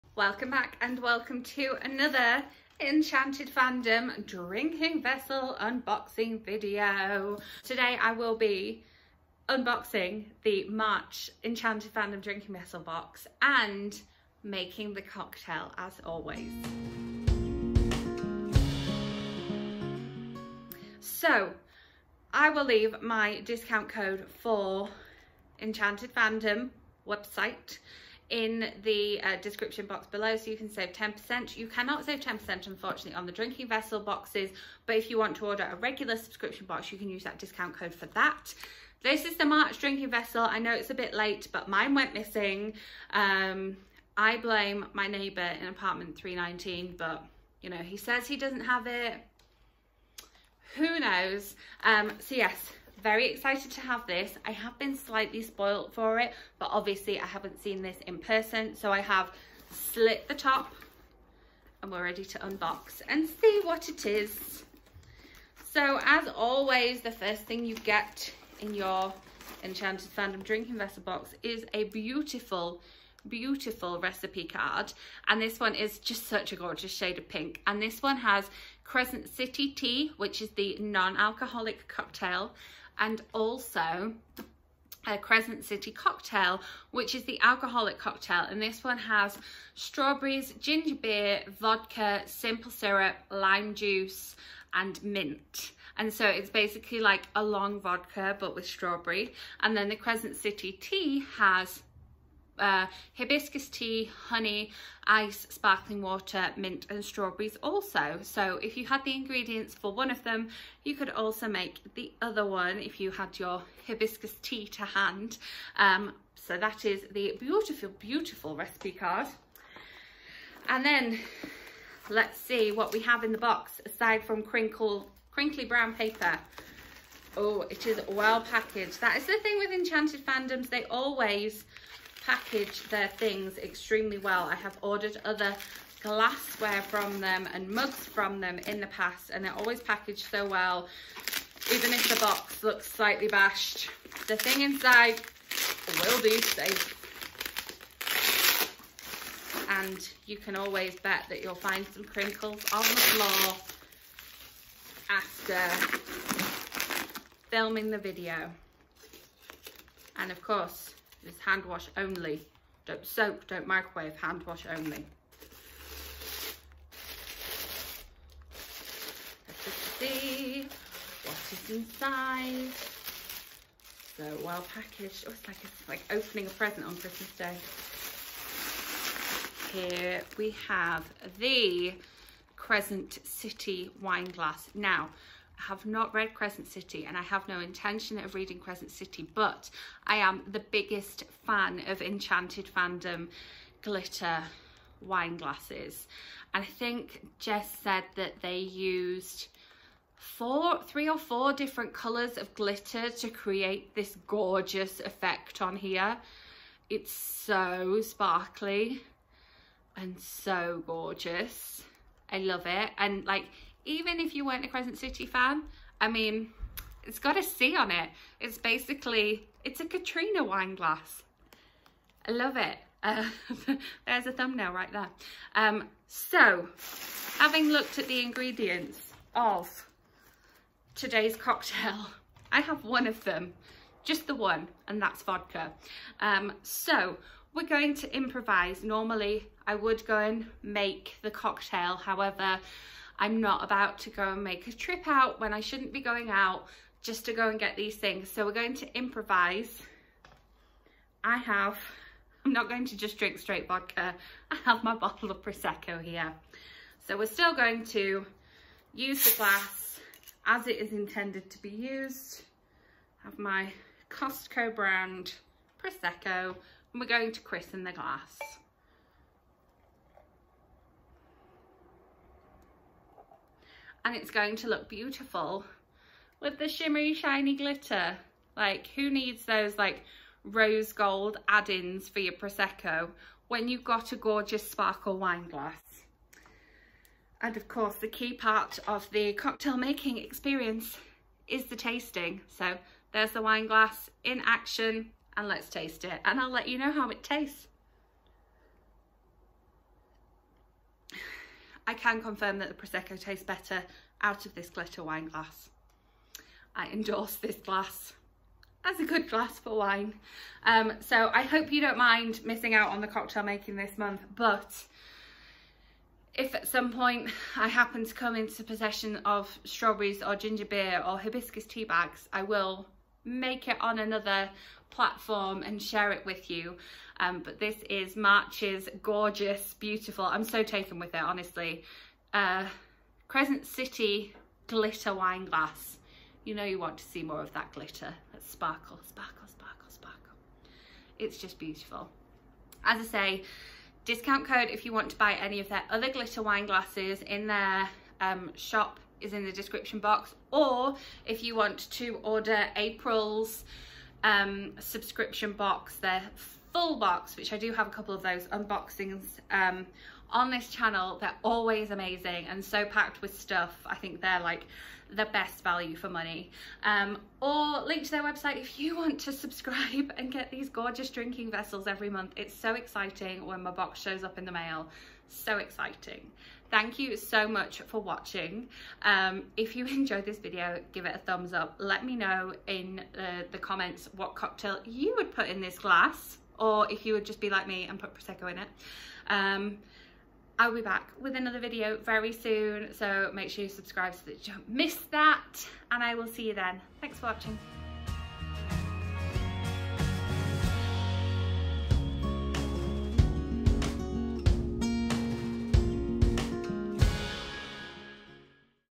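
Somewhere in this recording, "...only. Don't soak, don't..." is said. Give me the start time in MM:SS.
02:41.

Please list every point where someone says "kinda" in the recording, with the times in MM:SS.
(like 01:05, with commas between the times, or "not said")
not said.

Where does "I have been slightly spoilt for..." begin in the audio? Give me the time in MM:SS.
00:54.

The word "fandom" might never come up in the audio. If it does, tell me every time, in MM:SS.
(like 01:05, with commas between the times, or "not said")
00:03, 00:11, 00:26, 01:10, 02:10, 03:12.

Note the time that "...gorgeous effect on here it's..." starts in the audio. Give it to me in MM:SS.
03:24.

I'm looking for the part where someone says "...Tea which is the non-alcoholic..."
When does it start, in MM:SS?
01:19.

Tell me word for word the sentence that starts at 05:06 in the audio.
I endorse this glass as a good glass for wine.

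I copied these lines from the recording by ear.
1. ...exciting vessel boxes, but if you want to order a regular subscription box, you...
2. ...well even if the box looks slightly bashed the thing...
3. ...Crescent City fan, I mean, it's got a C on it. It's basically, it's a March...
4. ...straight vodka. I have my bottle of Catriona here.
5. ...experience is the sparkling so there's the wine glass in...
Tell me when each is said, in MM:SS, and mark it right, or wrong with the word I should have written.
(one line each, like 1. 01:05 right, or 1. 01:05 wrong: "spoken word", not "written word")
1. 00:33 wrong: "drinking", not "exciting"
2. 02:20 right
3. 03:34 wrong: "Catriona", not "March"
4. 04:13 wrong: "Prosecco", not "Catriona"
5. 04:50 wrong: "tasting", not "sparkling".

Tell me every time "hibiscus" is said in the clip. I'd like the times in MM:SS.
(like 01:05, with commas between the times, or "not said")
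01:43, 01:53, 05:21.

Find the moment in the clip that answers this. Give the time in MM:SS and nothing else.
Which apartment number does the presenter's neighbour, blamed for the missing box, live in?
00:46.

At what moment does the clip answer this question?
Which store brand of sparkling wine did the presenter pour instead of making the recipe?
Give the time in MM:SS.
04:24.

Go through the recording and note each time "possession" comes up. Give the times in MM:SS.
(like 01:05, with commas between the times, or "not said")
05:18.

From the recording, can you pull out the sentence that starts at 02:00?
And then let's see what we have in the box aside from crinkle, crinkly brown paper.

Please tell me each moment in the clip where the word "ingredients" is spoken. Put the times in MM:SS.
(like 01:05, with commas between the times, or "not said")
01:49, 03:48.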